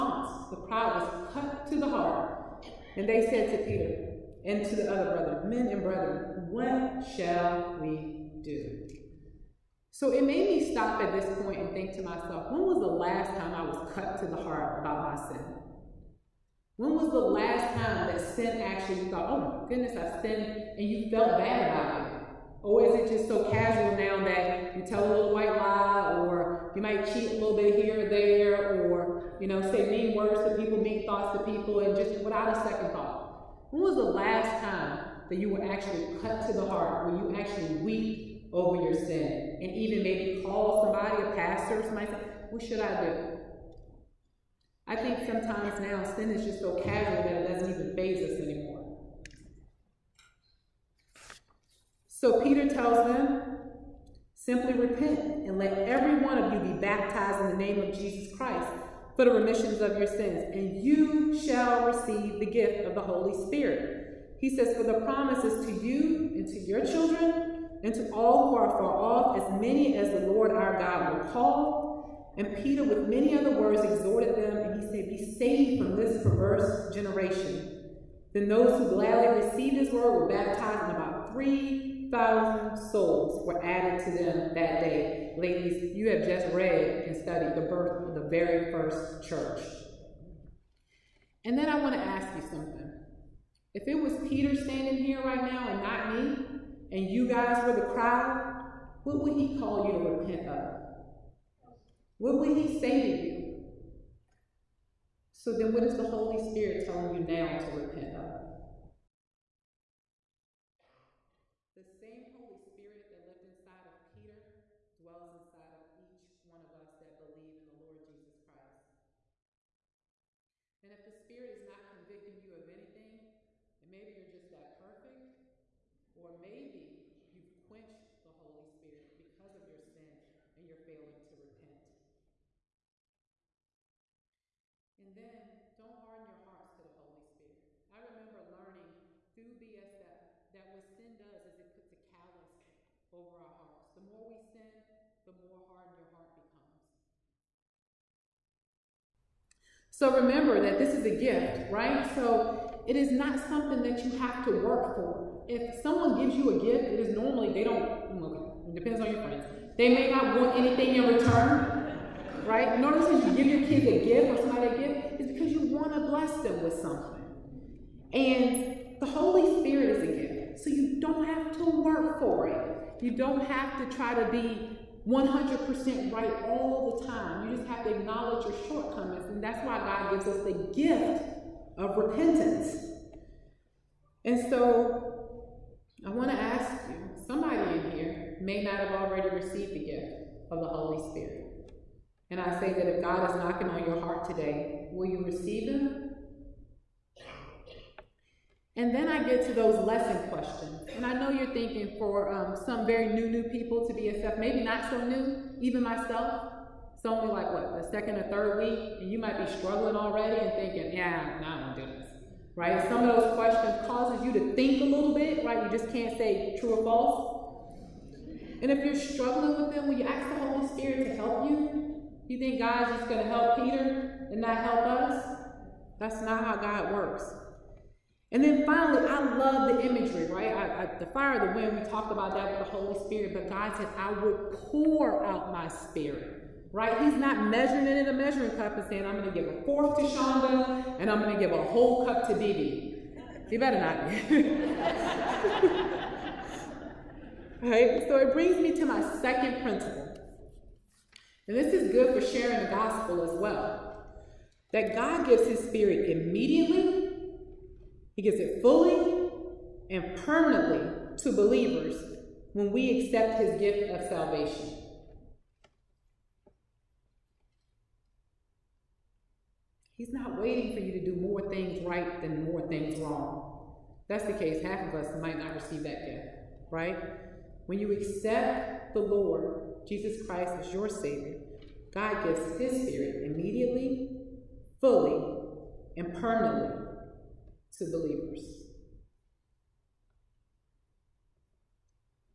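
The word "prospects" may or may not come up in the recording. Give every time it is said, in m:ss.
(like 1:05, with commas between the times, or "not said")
not said.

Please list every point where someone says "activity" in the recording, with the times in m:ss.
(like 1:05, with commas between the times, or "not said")
not said.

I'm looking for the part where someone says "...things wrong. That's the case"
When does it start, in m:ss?
4:32.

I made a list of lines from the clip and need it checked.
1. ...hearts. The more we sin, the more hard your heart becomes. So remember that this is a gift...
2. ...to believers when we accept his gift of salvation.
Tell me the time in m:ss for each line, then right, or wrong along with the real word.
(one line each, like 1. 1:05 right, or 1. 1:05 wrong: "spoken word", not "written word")
1. 2:23 right
2. 4:21 right.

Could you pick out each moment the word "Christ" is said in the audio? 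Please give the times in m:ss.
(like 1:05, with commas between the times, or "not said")
0:58, 1:58, 4:40.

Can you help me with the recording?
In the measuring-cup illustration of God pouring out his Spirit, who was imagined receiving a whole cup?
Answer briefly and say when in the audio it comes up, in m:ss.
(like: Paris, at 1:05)
Dee Dee, at 4:02.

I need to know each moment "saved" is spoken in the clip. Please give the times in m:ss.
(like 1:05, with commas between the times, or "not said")
1:15.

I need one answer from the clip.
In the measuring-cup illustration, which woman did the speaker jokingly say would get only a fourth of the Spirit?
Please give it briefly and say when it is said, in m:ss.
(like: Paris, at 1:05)
Shonda, at 4:00.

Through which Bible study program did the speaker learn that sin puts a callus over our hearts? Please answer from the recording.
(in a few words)
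BSF.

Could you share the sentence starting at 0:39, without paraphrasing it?
And even maybe call somebody, a pastor, somebody say, what should I do?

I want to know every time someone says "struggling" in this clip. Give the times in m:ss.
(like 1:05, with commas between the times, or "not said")
3:29, 3:38.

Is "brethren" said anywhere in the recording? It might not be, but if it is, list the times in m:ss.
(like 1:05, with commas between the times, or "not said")
0:05.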